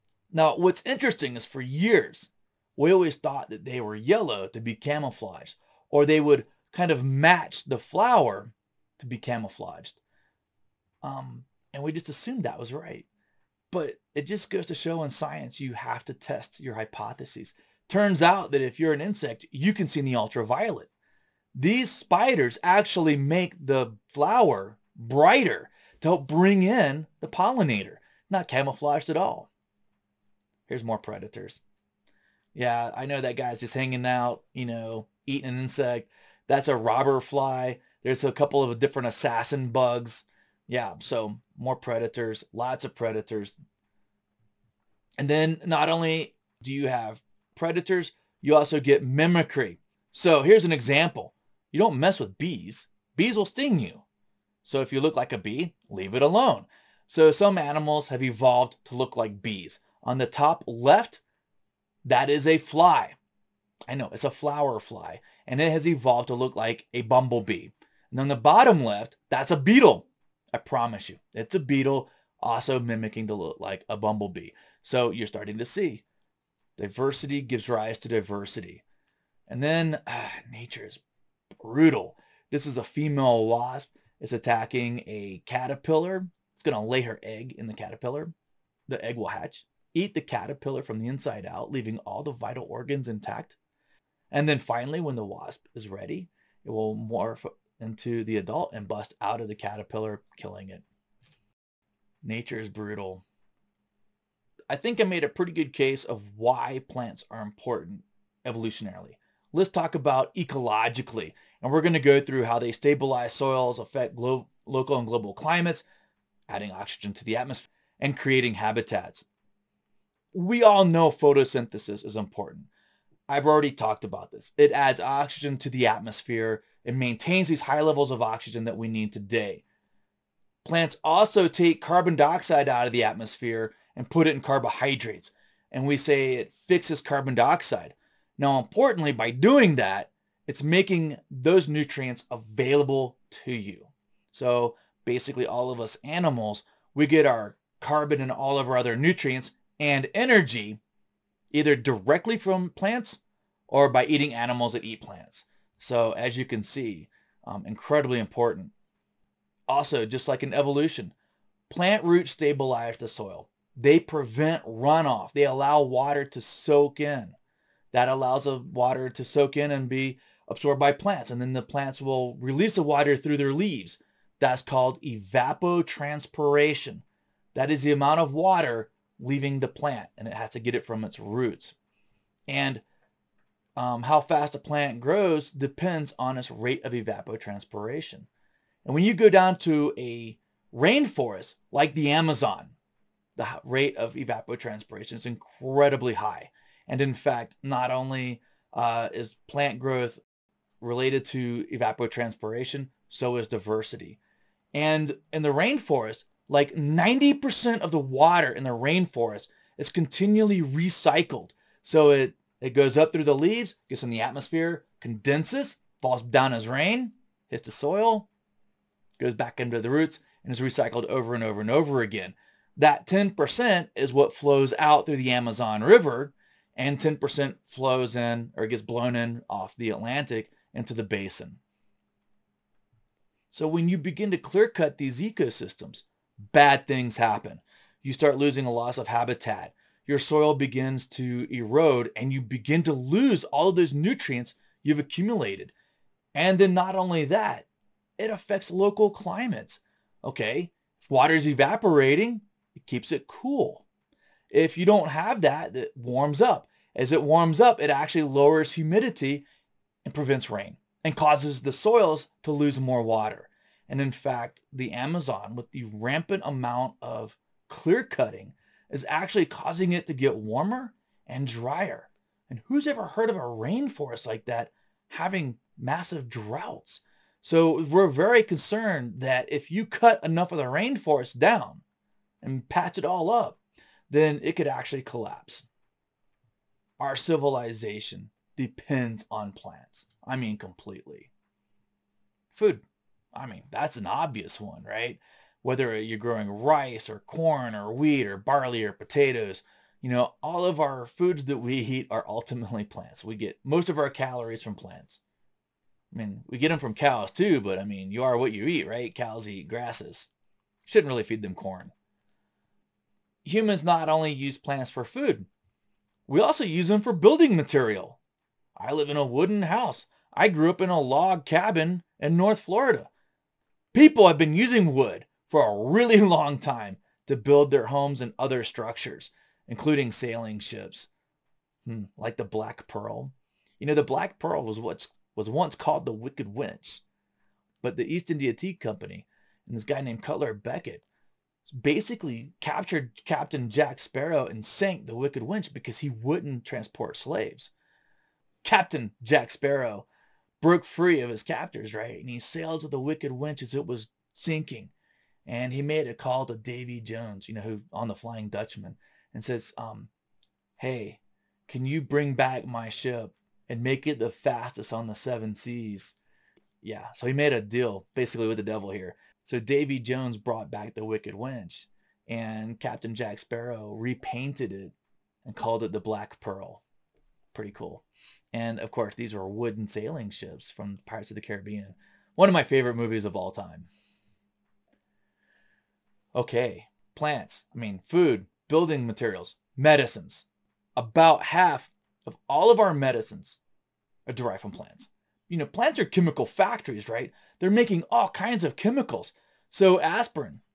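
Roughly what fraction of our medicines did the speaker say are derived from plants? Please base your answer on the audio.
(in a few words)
half.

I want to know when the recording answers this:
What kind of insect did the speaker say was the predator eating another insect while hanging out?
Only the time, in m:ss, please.
0:36.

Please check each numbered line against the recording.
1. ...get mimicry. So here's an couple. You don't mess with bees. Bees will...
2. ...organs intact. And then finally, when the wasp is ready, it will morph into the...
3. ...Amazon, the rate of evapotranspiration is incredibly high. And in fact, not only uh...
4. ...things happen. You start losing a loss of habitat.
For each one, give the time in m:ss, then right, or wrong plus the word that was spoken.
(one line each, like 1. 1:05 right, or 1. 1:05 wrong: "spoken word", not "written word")
1. 0:48 wrong: "example", not "couple"
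2. 1:32 right
3. 3:12 right
4. 3:56 right.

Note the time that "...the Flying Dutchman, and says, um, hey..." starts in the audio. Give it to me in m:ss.
5:58.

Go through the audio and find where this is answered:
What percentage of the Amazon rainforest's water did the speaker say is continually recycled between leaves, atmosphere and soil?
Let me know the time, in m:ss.
3:26.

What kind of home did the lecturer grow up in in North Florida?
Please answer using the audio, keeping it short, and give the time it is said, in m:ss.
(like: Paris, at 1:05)
log cabin, at 5:20.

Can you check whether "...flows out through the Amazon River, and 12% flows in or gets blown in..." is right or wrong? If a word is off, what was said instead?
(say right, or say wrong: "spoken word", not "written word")
wrong: "10", not "12".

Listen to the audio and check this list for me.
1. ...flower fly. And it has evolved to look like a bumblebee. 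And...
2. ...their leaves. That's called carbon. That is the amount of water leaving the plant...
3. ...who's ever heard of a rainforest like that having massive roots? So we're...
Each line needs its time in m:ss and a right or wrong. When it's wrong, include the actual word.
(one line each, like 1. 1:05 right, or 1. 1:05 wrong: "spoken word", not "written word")
1. 1:04 right
2. 2:53 wrong: "evapotranspiration", not "carbon"
3. 4:32 wrong: "droughts", not "roots".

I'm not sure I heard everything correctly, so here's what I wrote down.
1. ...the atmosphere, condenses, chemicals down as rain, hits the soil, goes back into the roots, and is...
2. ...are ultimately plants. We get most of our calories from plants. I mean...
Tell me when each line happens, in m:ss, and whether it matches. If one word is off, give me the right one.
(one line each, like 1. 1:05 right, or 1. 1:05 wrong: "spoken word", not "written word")
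1. 3:34 wrong: "falls", not "chemicals"
2. 5:02 right.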